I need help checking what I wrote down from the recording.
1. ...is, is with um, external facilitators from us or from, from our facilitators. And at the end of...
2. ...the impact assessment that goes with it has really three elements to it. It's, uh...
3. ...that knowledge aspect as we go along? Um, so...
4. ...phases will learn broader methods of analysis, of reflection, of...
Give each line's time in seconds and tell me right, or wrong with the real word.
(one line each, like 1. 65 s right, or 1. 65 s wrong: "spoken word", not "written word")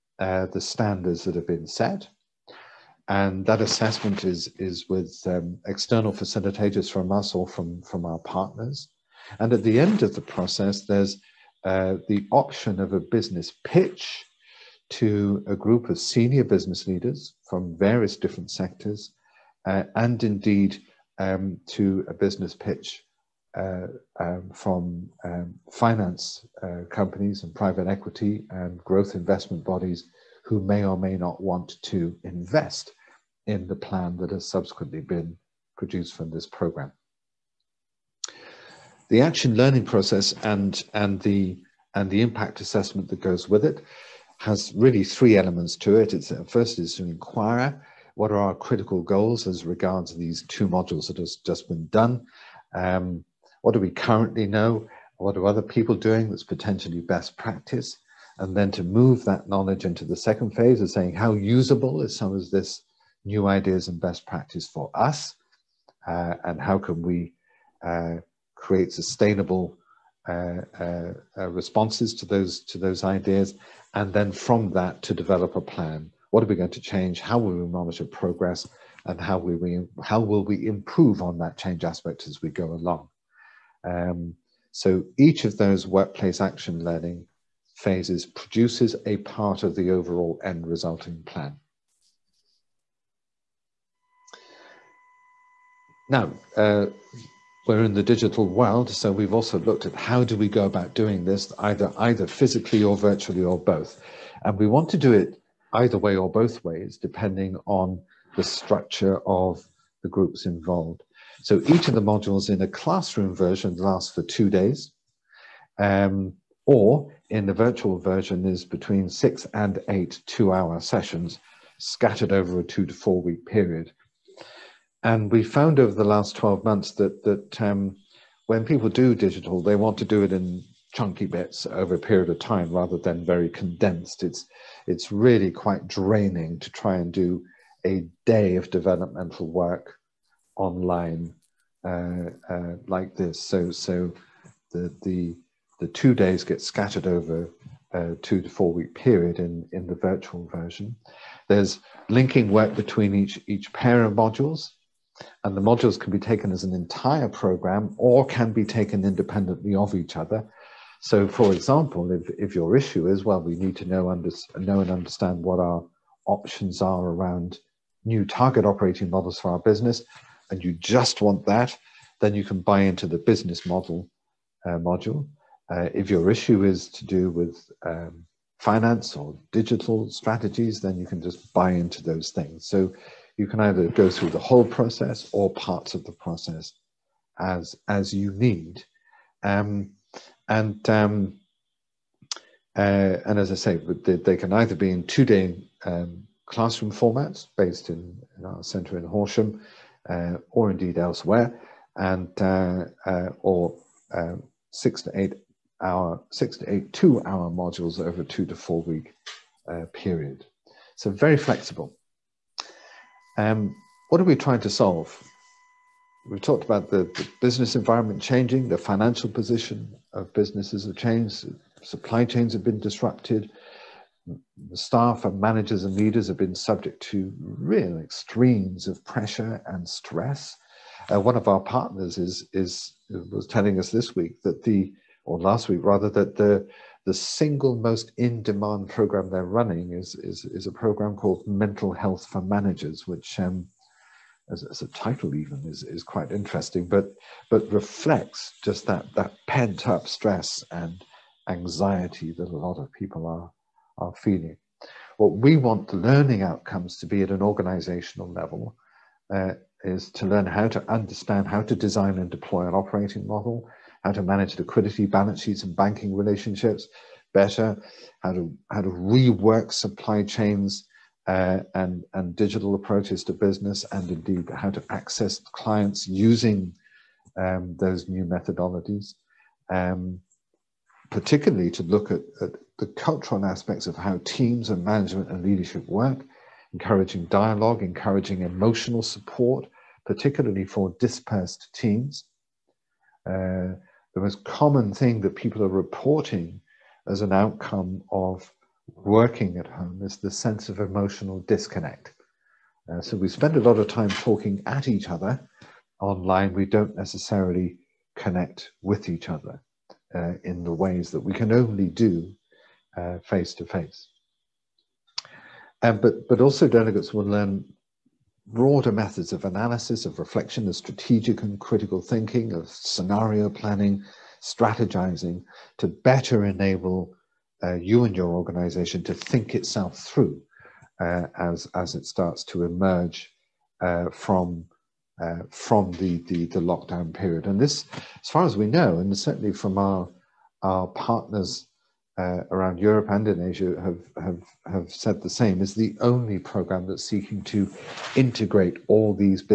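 1. 4 s wrong: "partners", not "facilitators"
2. 42 s right
3. 81 s wrong: "change", not "knowledge"
4. 316 s wrong: "delegates", not "phases".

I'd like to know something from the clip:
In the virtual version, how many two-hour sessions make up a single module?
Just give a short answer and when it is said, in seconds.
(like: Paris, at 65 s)
6 to 8, at 119 s.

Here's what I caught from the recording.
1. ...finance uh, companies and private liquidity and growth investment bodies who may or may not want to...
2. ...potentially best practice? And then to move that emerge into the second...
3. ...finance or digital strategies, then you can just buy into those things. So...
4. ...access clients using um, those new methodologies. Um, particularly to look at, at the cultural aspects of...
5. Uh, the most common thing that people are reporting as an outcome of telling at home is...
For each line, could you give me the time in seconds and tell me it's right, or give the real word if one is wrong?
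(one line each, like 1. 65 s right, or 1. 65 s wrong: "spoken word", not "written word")
1. 25 s wrong: "equity", not "liquidity"
2. 56 s wrong: "knowledge", not "emerge"
3. 178 s right
4. 274 s right
5. 293 s wrong: "working", not "telling".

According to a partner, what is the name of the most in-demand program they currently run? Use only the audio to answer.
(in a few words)
Mental Health for Managers.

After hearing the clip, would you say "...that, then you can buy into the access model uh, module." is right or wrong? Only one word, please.
wrong.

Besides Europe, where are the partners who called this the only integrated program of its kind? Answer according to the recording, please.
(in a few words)
Asia.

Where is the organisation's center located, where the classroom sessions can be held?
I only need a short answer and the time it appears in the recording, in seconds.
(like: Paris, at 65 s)
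Horsham, at 199 s.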